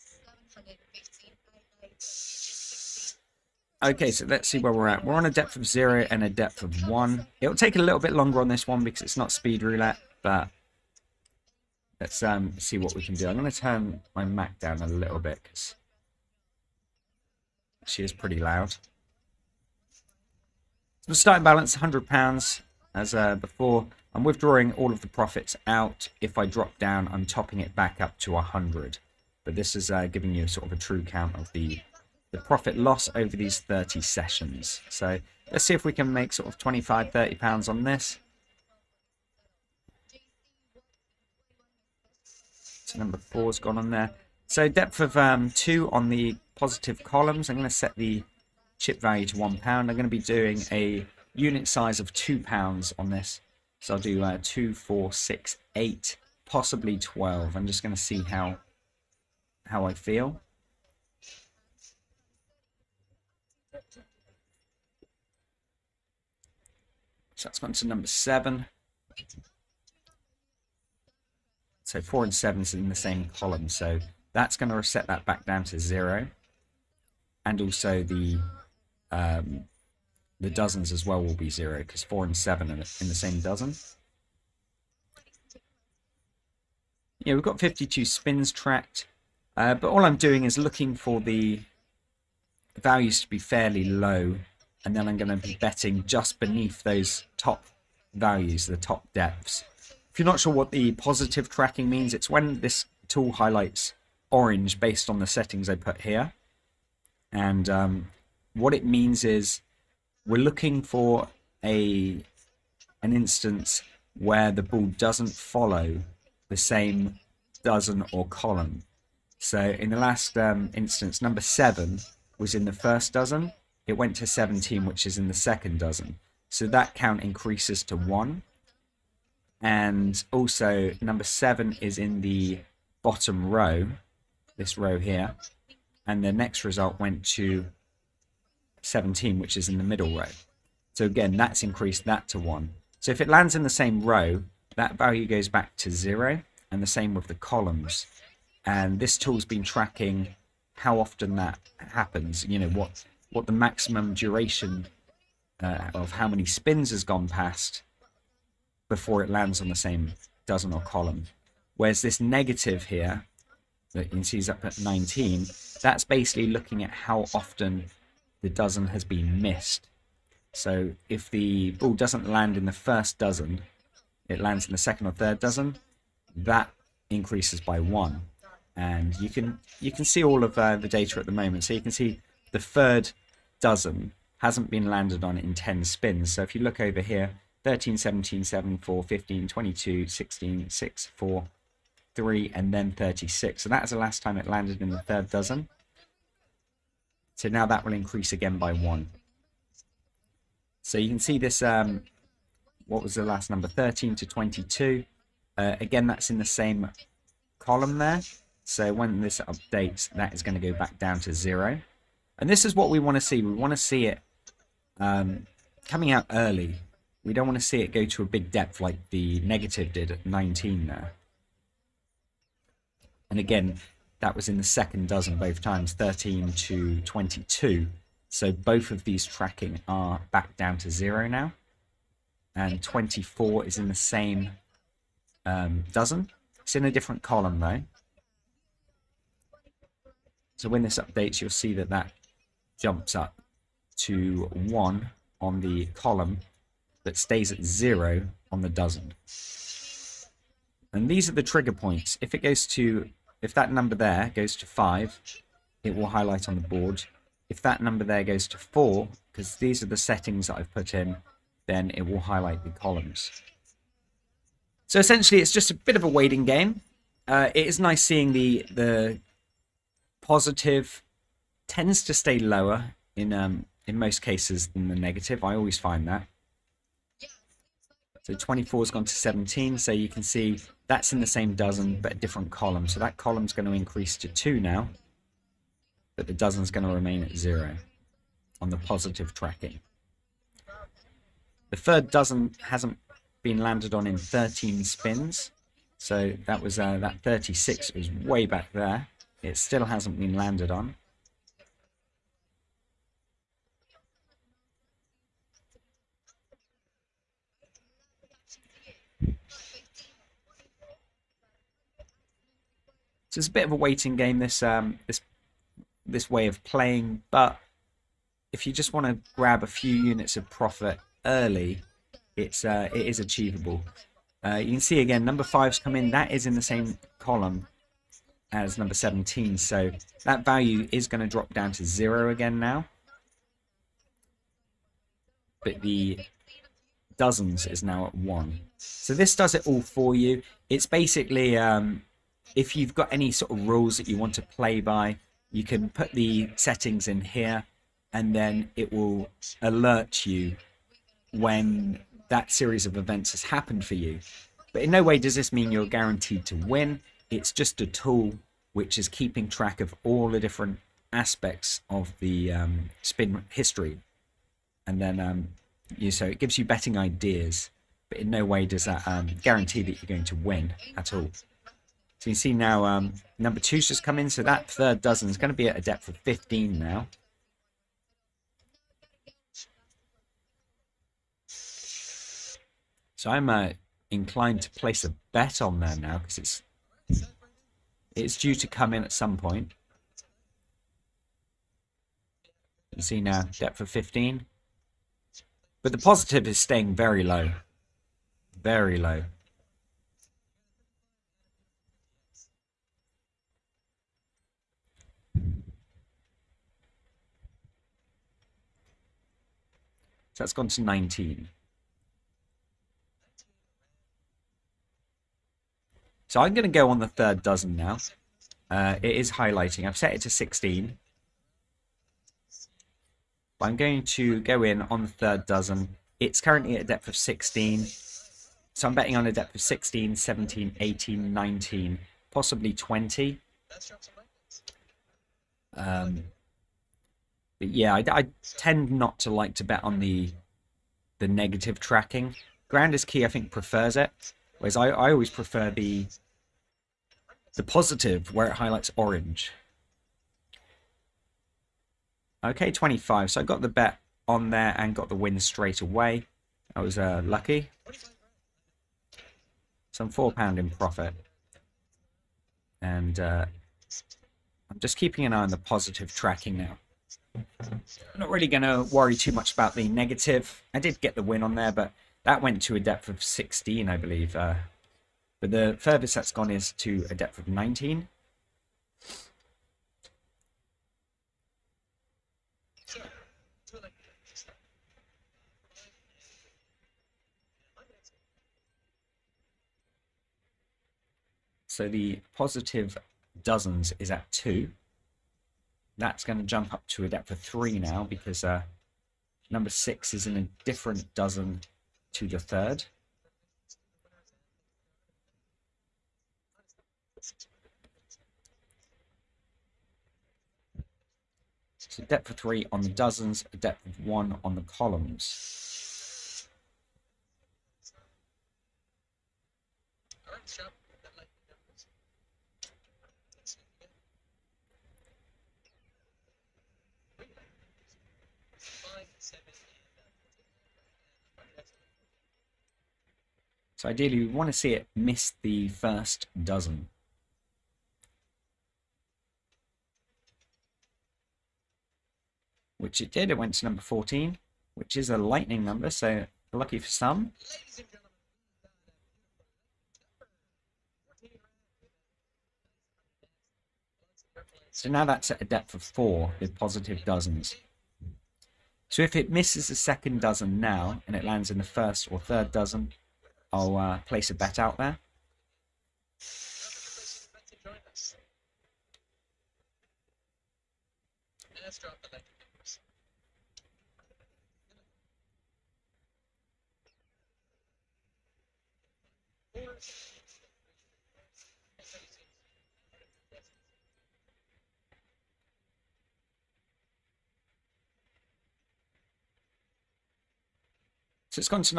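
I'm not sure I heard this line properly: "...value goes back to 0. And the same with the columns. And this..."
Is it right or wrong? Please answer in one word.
right.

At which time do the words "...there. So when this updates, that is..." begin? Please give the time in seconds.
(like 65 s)
207 s.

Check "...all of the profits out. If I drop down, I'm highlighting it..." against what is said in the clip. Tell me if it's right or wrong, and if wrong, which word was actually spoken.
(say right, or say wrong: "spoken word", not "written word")
wrong: "topping", not "highlighting".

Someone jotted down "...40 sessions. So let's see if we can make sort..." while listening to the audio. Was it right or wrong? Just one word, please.
wrong.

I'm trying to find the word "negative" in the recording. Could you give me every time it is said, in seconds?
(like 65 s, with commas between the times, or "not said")
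162 s, 219 s, 274 s, 441 s, 469 s.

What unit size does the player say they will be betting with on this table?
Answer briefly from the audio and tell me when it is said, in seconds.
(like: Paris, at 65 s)
two pounds, at 52 s.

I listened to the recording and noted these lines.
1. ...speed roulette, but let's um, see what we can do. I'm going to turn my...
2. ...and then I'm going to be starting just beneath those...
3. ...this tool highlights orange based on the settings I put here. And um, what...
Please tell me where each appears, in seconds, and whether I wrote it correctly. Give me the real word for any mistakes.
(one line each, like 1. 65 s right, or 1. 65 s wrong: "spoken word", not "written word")
1. 9 s right
2. 94 s wrong: "betting", not "starting"
3. 102 s right.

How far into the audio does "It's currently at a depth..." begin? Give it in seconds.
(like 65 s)
426 s.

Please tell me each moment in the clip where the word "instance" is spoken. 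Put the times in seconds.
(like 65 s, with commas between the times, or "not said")
113 s, 120 s.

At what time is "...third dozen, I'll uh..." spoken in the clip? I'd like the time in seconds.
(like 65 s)
562 s.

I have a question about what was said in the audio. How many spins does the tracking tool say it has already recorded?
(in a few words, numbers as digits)
52.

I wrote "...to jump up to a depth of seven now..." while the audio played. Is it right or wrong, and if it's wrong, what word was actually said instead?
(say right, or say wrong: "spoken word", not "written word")
wrong: "three", not "seven".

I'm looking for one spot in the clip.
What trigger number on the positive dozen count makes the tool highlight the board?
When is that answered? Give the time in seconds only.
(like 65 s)
254 s.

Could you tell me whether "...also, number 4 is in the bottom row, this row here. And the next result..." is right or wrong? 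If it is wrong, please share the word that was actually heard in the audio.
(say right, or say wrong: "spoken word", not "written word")
wrong: "7", not "4".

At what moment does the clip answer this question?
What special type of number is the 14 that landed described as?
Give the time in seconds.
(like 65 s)
545 s.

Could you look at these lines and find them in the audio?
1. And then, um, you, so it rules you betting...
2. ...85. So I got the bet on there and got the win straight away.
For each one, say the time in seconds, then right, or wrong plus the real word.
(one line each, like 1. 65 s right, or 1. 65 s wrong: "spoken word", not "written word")
1. 364 s wrong: "gives", not "rules"
2. 452 s wrong: "25", not "85".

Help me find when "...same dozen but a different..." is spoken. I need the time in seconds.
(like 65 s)
281 s.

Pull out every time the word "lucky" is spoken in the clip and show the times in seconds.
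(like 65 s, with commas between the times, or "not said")
457 s, 546 s.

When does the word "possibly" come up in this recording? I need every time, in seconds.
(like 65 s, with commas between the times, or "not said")
56 s, 432 s.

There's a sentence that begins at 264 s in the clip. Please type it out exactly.
So essentially, it's just a bit of a waiting game.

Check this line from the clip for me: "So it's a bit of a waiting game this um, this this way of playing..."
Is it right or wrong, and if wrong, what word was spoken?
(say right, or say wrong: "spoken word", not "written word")
right.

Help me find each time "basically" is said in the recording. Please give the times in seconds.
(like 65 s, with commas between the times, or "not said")
166 s, 340 s.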